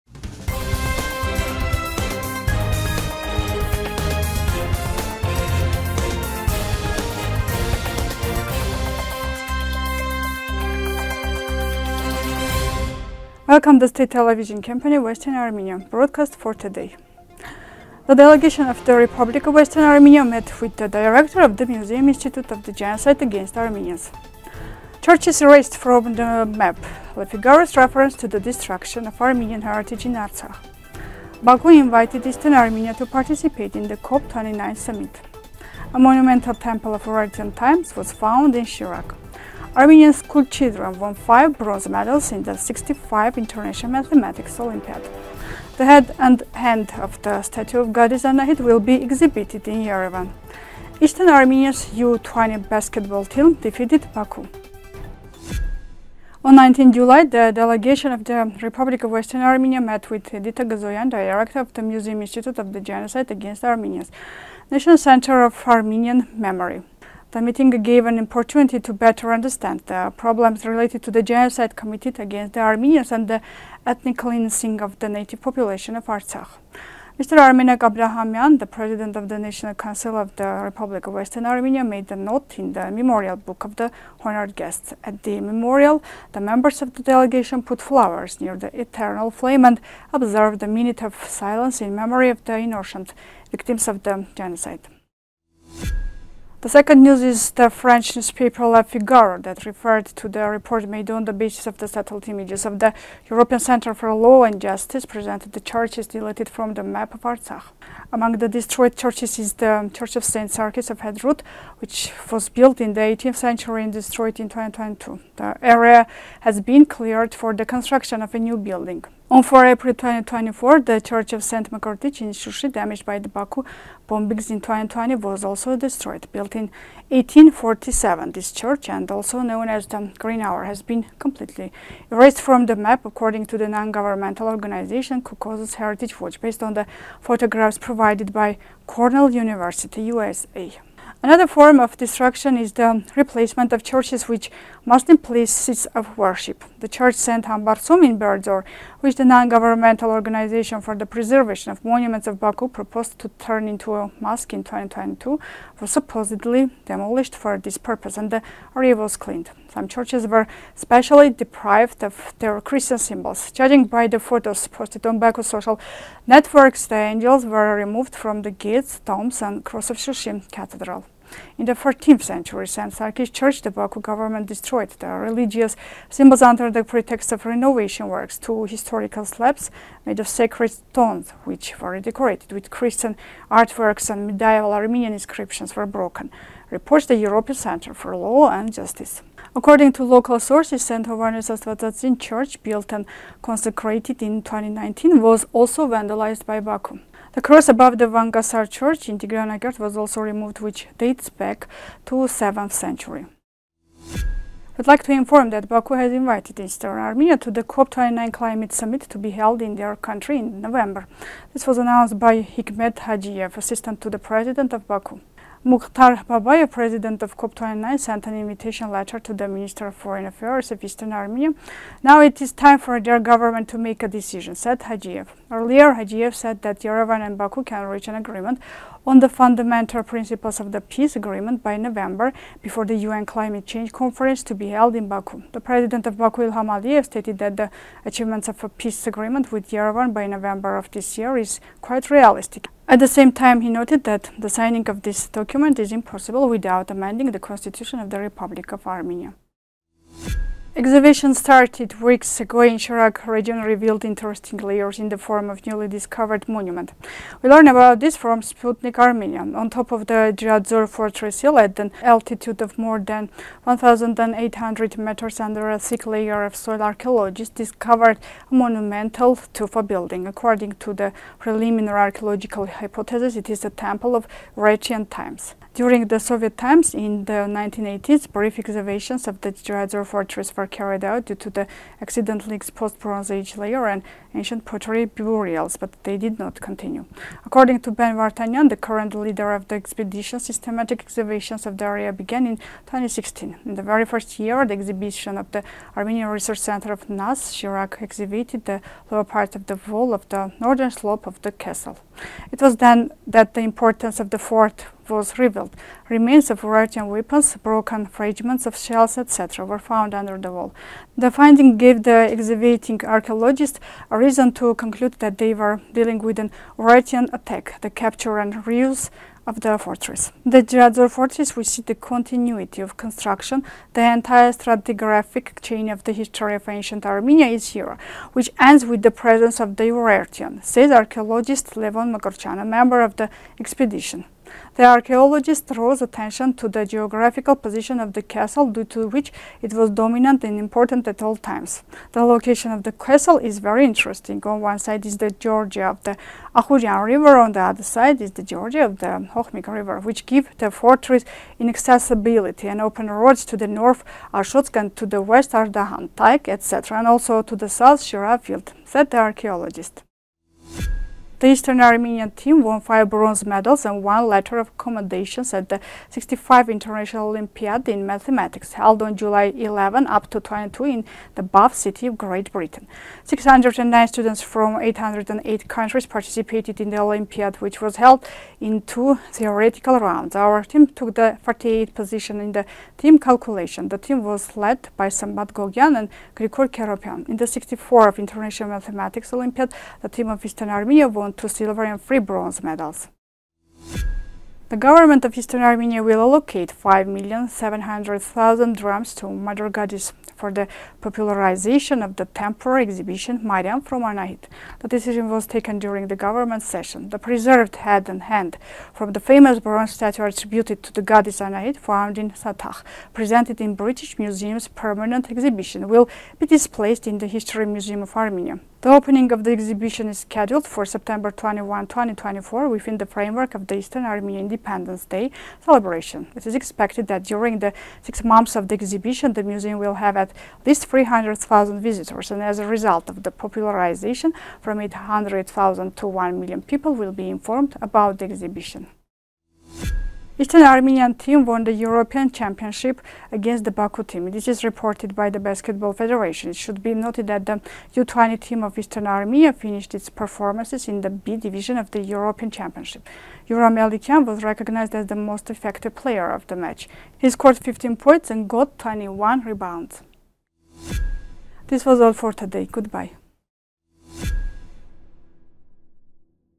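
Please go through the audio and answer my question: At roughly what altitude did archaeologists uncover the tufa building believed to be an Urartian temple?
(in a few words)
more than 1,800 meters.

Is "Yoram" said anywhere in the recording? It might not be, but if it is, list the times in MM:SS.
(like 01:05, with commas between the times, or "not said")
07:33.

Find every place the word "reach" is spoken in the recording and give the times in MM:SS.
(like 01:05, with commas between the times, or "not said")
03:47.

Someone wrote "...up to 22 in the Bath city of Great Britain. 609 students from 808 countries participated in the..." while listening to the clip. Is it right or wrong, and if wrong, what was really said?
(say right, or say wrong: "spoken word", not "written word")
right.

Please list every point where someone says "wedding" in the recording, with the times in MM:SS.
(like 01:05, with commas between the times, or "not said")
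not said.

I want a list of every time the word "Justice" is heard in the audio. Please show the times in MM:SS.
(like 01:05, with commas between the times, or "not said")
01:44, 03:08.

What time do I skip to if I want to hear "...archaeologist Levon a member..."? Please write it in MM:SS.
05:30.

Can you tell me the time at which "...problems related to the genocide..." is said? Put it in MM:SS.
01:10.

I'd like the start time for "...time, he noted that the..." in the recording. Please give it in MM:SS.
04:03.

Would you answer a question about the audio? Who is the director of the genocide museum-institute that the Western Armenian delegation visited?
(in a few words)
Edita Gzoyan.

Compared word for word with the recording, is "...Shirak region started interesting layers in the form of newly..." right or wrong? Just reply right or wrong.
wrong.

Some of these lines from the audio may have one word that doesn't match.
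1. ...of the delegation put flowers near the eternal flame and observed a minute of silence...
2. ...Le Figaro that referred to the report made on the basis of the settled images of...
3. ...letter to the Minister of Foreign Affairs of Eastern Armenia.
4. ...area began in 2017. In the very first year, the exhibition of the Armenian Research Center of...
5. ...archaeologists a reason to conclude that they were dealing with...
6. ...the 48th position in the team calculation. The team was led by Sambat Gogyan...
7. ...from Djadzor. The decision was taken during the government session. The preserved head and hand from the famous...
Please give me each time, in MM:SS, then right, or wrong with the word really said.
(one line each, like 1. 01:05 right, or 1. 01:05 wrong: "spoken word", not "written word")
1. 01:26 right
2. 01:38 right
3. 03:38 right
4. 04:51 wrong: "2016", not "2017"
5. 05:13 right
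6. 06:21 right
7. 06:43 wrong: "Anahit", not "Djadzor".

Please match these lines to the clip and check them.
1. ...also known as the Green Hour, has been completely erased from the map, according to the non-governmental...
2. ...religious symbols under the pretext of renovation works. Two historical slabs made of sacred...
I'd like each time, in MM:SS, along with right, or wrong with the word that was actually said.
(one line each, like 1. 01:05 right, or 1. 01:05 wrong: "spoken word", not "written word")
1. 02:09 right
2. 02:55 right.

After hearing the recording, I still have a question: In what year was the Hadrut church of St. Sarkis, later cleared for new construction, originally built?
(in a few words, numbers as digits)
18th century.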